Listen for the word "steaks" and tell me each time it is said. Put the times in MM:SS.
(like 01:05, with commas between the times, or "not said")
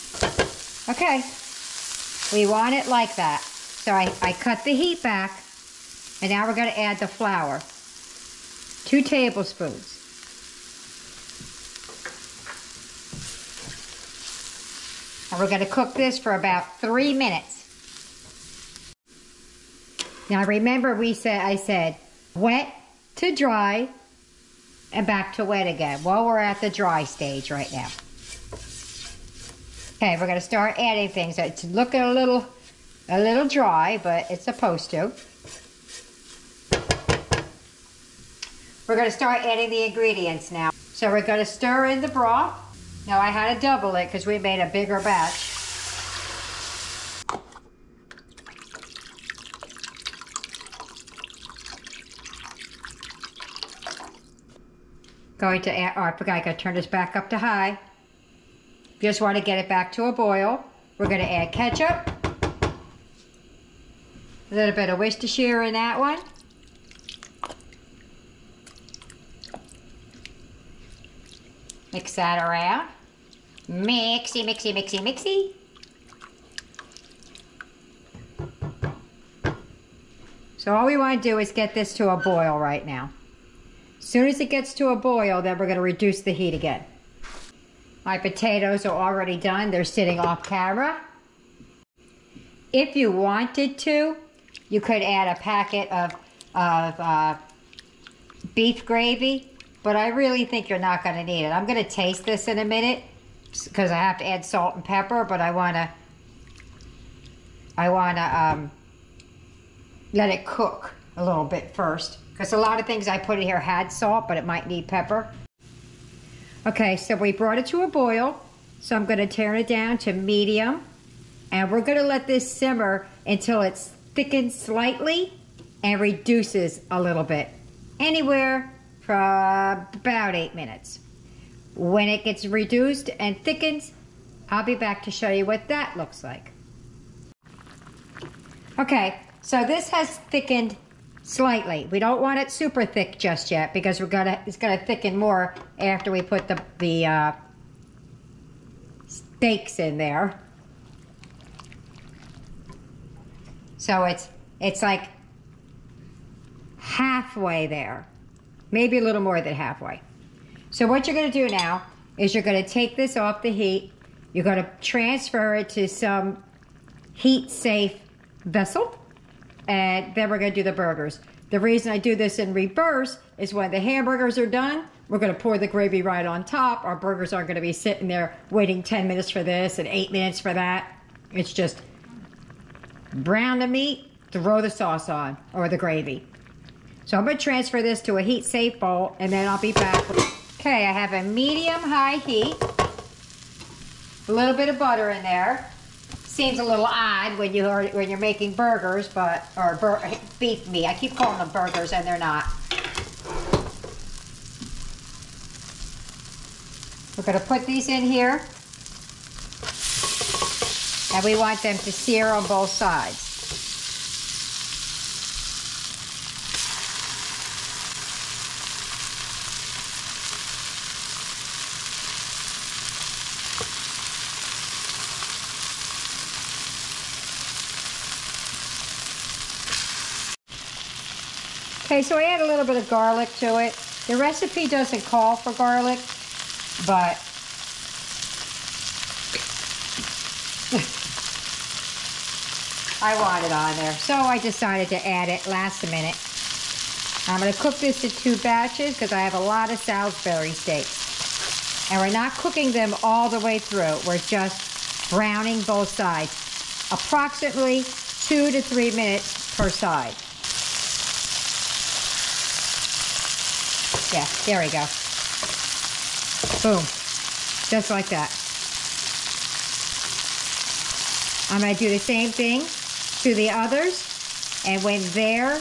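02:29, 04:10.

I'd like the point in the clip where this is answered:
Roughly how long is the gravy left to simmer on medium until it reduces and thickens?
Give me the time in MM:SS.
02:09.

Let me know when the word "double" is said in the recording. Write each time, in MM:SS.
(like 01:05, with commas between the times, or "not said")
00:43.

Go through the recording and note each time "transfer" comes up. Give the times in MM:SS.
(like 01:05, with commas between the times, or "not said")
02:44, 03:07.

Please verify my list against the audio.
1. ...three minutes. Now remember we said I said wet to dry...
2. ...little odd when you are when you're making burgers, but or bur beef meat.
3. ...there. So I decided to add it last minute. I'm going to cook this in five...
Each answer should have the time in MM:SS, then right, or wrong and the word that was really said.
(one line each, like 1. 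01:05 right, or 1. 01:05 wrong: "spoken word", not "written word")
1. 00:16 right
2. 03:16 right
3. 04:03 wrong: "two", not "five".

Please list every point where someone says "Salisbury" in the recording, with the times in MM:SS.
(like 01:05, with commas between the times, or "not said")
04:09.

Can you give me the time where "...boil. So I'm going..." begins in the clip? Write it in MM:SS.
01:57.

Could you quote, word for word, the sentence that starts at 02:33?
So it's it's like halfway there maybe a little more than halfway.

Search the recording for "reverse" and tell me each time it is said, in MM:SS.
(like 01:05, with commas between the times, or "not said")
02:52.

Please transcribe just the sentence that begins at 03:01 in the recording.
It's just brown the meat, throw the sauce on or the gravy.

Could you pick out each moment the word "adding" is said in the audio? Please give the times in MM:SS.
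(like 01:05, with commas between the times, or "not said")
00:30, 00:39.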